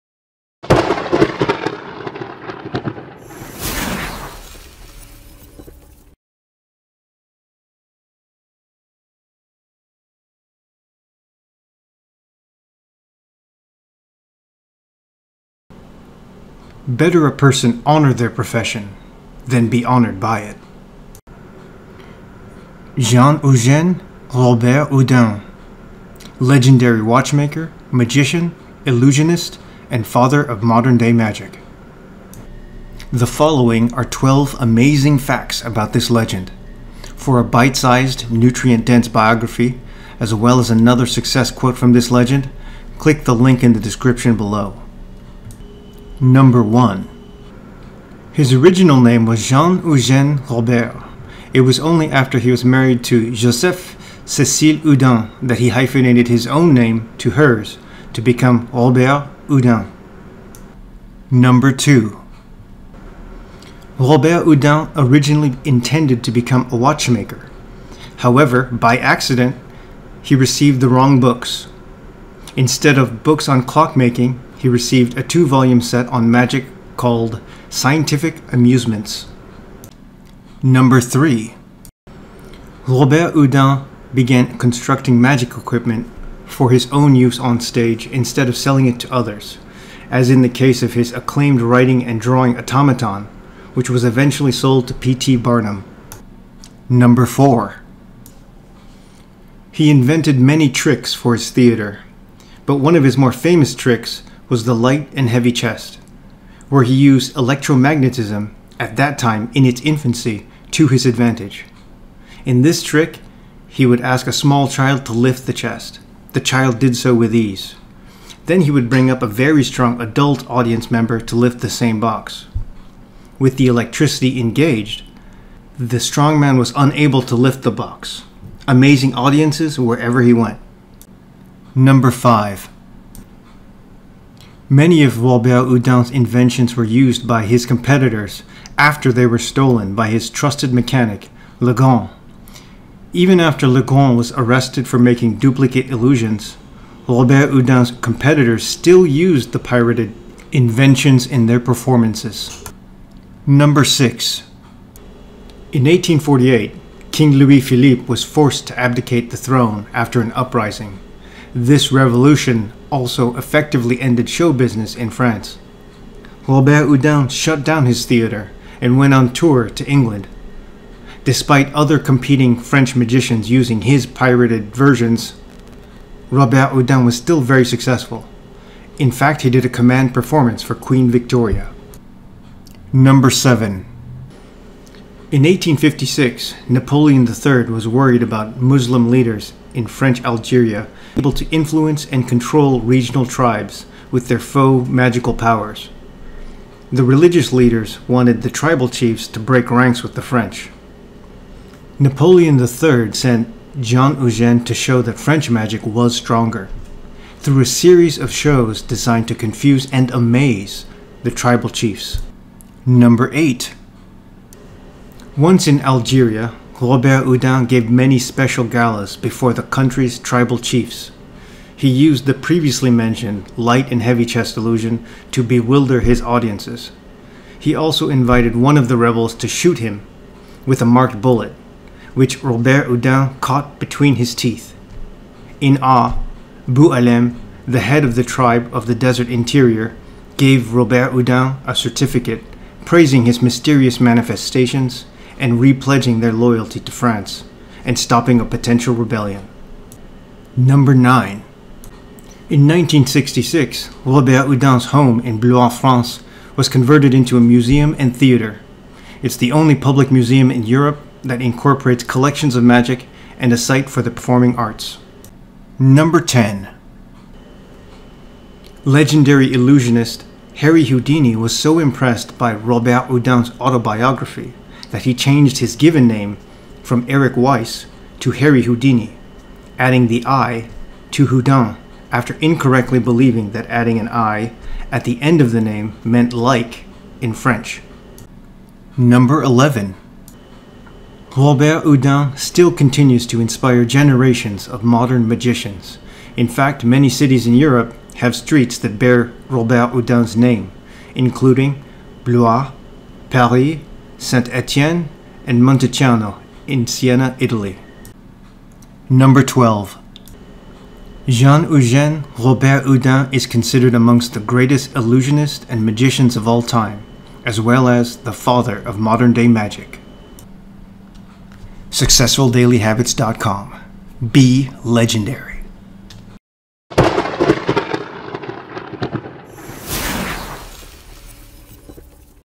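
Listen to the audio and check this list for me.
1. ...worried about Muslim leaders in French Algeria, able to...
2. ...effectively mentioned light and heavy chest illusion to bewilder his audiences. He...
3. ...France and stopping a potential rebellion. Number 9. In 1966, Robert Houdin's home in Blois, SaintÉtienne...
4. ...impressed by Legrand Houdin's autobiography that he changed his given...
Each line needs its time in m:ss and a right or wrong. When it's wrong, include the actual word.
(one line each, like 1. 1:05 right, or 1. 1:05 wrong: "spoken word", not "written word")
1. 3:07 right
2. 3:42 wrong: "previously", not "effectively"
3. 4:06 wrong: "France", not "SaintÉtienne"
4. 4:31 wrong: "Robert", not "Legrand".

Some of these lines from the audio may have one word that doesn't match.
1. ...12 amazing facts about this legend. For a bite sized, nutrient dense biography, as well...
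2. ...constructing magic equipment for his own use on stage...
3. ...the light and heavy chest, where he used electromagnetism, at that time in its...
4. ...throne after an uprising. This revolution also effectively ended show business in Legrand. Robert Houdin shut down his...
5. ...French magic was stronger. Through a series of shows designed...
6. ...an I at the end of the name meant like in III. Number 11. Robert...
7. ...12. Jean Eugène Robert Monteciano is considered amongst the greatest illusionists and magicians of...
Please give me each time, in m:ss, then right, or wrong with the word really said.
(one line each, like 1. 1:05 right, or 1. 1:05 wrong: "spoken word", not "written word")
1. 0:34 right
2. 1:24 right
3. 1:44 right
4. 2:39 wrong: "France", not "Legrand"
5. 3:25 right
6. 4:43 wrong: "French", not "III"
7. 5:09 wrong: "Houdin", not "Monteciano".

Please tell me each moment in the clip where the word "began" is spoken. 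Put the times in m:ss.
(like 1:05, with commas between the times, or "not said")
1:24.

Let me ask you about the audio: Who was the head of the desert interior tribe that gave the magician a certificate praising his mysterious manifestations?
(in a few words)
Boualem.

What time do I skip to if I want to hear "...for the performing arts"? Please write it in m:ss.
4:23.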